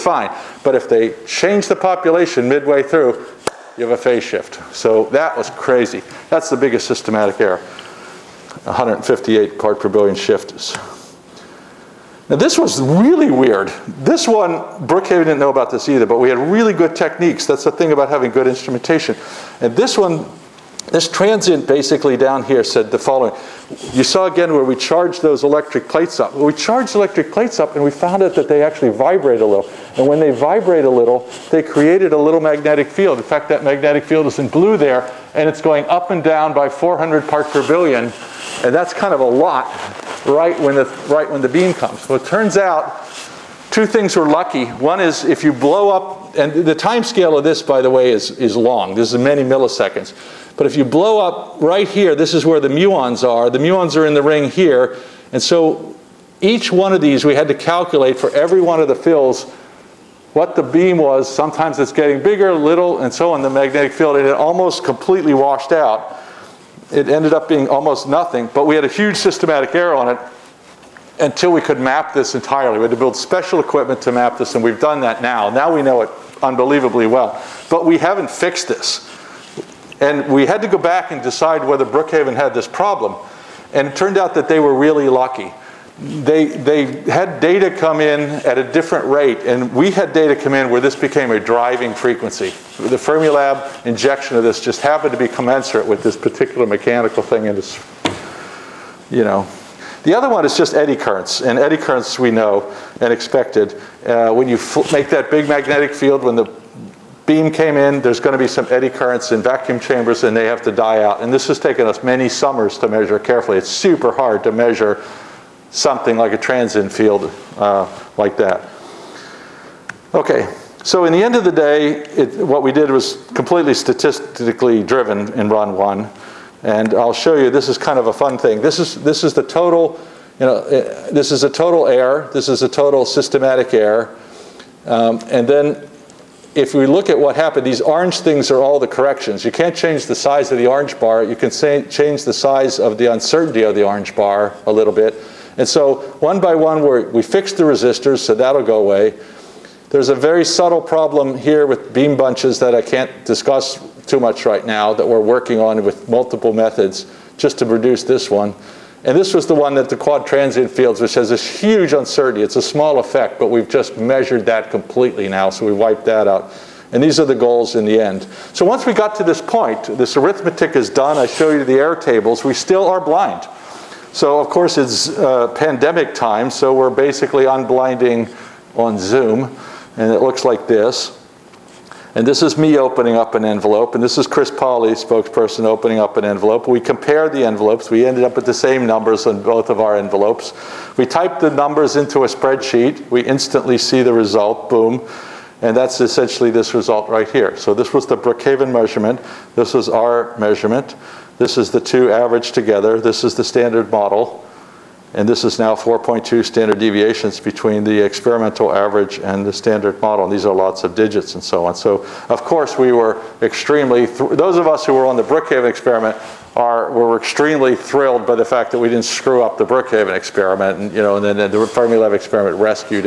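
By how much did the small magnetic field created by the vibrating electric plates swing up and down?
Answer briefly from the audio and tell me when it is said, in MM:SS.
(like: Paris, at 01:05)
400 parts per billion, at 00:36.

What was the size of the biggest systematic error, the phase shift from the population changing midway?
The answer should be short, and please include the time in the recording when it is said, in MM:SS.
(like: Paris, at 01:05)
158 parts per billion, at 00:08.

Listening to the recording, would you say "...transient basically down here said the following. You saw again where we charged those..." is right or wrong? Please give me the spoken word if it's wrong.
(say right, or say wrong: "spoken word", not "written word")
right.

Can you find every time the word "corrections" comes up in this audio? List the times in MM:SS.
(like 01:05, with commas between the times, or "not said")
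02:18.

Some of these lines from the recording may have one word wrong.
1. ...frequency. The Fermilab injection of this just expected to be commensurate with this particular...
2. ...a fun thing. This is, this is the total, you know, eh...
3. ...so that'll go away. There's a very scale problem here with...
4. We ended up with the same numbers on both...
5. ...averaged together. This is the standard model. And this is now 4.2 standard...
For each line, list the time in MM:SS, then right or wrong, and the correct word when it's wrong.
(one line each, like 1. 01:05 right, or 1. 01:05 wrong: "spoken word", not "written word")
1. 01:31 wrong: "happened", not "expected"
2. 02:08 right
3. 02:28 wrong: "subtle", not "scale"
4. 03:07 right
5. 03:22 right.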